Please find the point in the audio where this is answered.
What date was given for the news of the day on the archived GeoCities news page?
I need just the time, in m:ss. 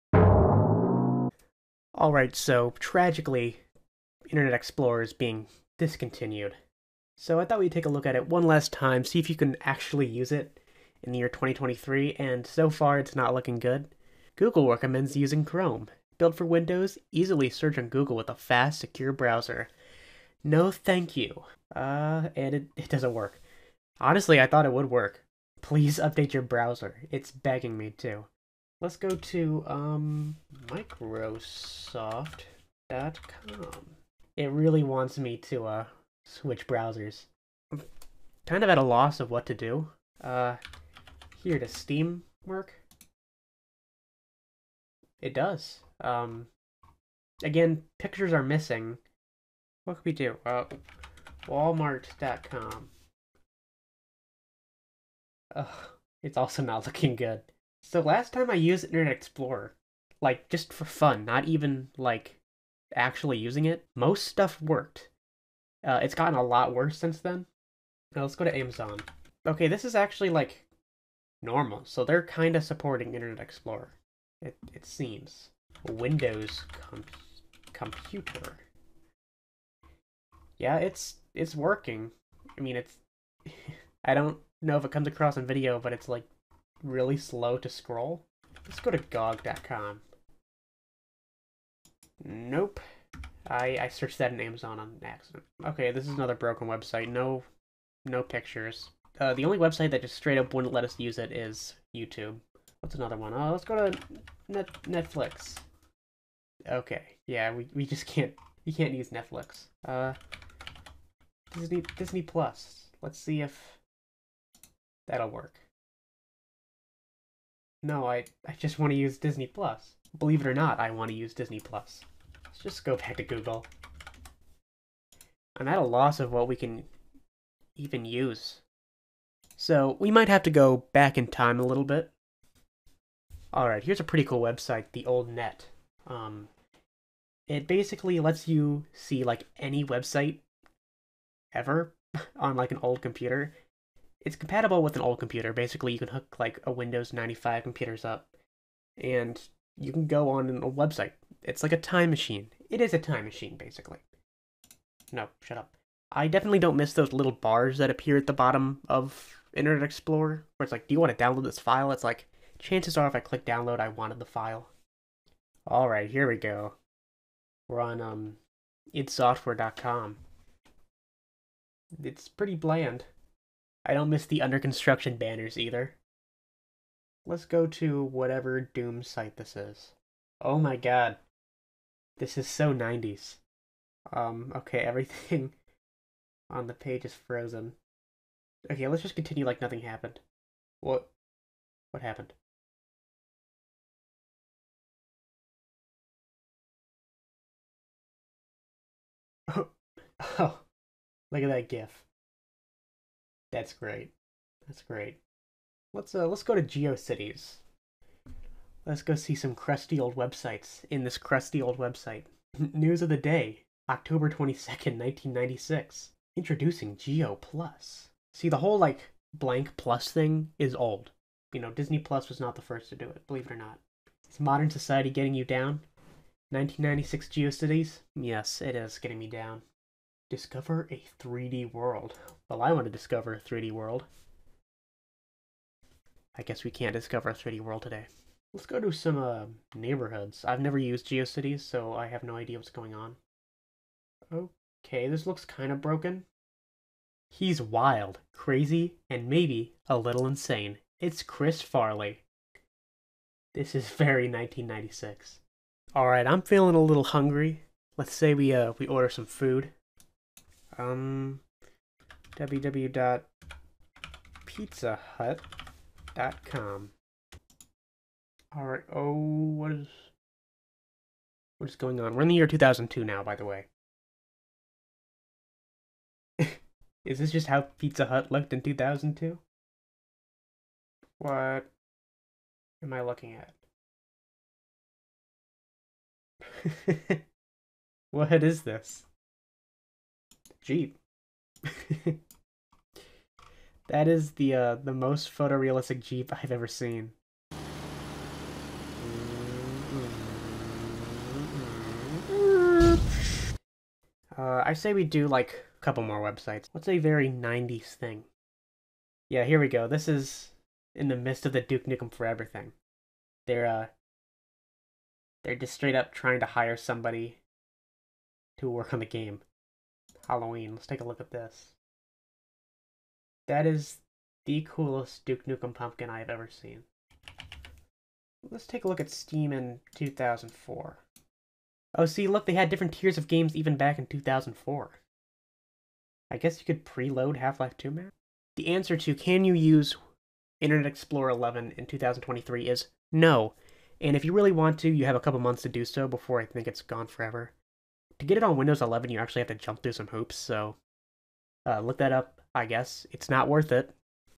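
3:33.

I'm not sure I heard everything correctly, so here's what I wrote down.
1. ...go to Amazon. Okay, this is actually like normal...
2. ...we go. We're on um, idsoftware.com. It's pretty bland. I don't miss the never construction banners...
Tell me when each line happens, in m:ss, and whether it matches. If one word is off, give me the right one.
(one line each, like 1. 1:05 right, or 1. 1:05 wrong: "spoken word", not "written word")
1. 1:08 right
2. 2:46 wrong: "under", not "never".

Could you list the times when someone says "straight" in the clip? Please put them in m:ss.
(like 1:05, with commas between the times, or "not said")
1:40, 5:15.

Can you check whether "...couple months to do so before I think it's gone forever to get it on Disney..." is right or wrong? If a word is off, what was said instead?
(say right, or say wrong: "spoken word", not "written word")
wrong: "Windows", not "Disney".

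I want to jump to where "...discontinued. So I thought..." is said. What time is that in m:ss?
0:05.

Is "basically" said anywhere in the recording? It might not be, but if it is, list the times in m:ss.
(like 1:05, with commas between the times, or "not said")
2:17, 2:25, 2:33.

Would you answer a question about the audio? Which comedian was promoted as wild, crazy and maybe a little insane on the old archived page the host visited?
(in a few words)
Chris Farley.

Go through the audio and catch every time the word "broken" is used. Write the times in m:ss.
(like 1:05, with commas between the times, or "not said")
1:36, 4:05.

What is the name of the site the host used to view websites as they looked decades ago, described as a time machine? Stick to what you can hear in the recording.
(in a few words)
The Old Net.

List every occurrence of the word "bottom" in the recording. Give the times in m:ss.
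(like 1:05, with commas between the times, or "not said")
2:38.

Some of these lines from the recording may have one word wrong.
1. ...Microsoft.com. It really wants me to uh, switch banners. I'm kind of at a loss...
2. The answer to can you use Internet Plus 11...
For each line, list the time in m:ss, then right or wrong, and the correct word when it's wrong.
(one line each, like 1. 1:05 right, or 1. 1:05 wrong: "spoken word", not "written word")
1. 0:30 wrong: "browsers", not "banners"
2. 5:38 wrong: "Explorer", not "Plus".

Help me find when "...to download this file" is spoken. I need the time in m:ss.
2:41.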